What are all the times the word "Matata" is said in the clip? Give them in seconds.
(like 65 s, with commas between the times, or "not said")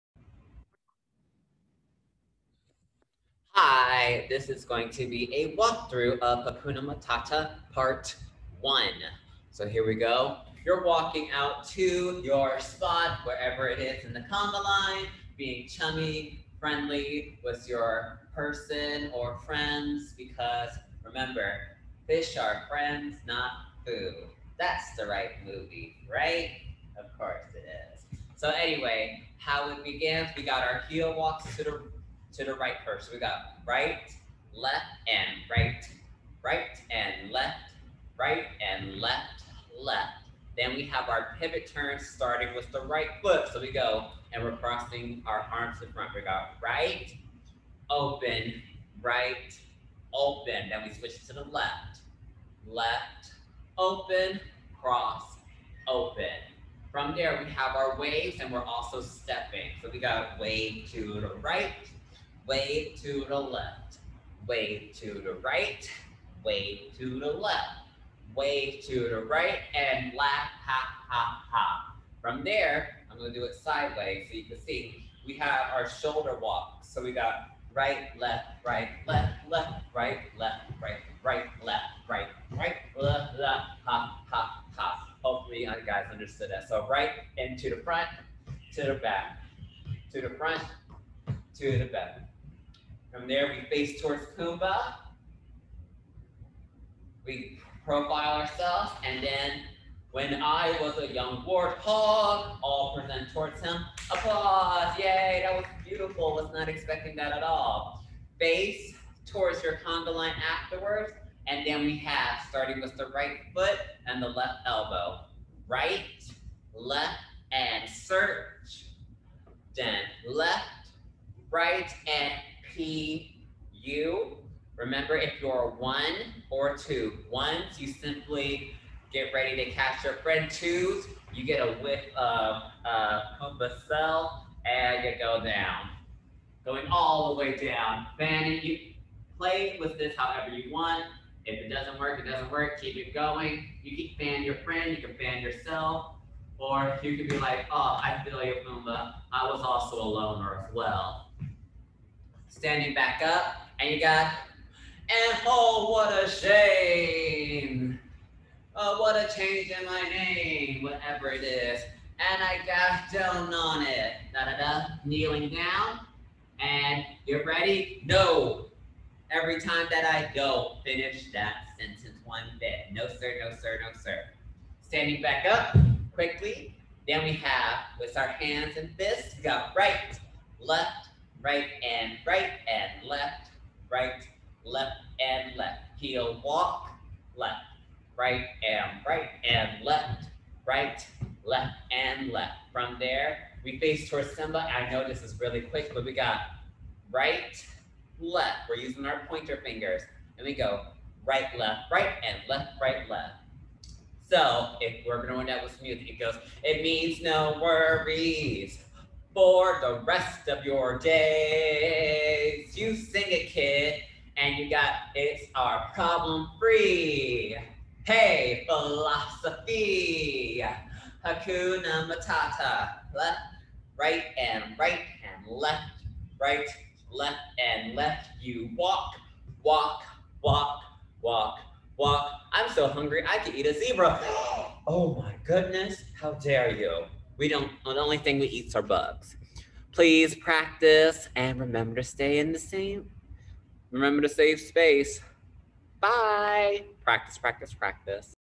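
6 s, 222 s.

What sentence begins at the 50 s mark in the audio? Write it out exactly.
Then we switch to the left, left, open, cross, open.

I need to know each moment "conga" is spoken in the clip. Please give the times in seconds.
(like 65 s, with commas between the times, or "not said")
14 s.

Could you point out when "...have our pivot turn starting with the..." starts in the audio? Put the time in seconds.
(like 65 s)
40 s.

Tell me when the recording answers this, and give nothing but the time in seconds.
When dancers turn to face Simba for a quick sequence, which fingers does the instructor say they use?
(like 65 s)
199 s.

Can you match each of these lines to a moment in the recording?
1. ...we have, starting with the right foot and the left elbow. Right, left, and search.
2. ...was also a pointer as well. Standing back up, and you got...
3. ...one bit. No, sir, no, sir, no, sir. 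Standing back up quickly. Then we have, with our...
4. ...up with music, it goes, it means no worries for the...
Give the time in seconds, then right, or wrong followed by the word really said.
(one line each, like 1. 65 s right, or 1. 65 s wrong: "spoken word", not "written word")
1. 111 s right
2. 149 s wrong: "loner", not "pointer"
3. 172 s right
4. 205 s right.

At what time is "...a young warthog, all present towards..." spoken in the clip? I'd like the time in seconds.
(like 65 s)
100 s.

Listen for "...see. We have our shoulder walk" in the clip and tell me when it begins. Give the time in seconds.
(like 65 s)
74 s.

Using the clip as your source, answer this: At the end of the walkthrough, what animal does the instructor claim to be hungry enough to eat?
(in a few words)
A zebra.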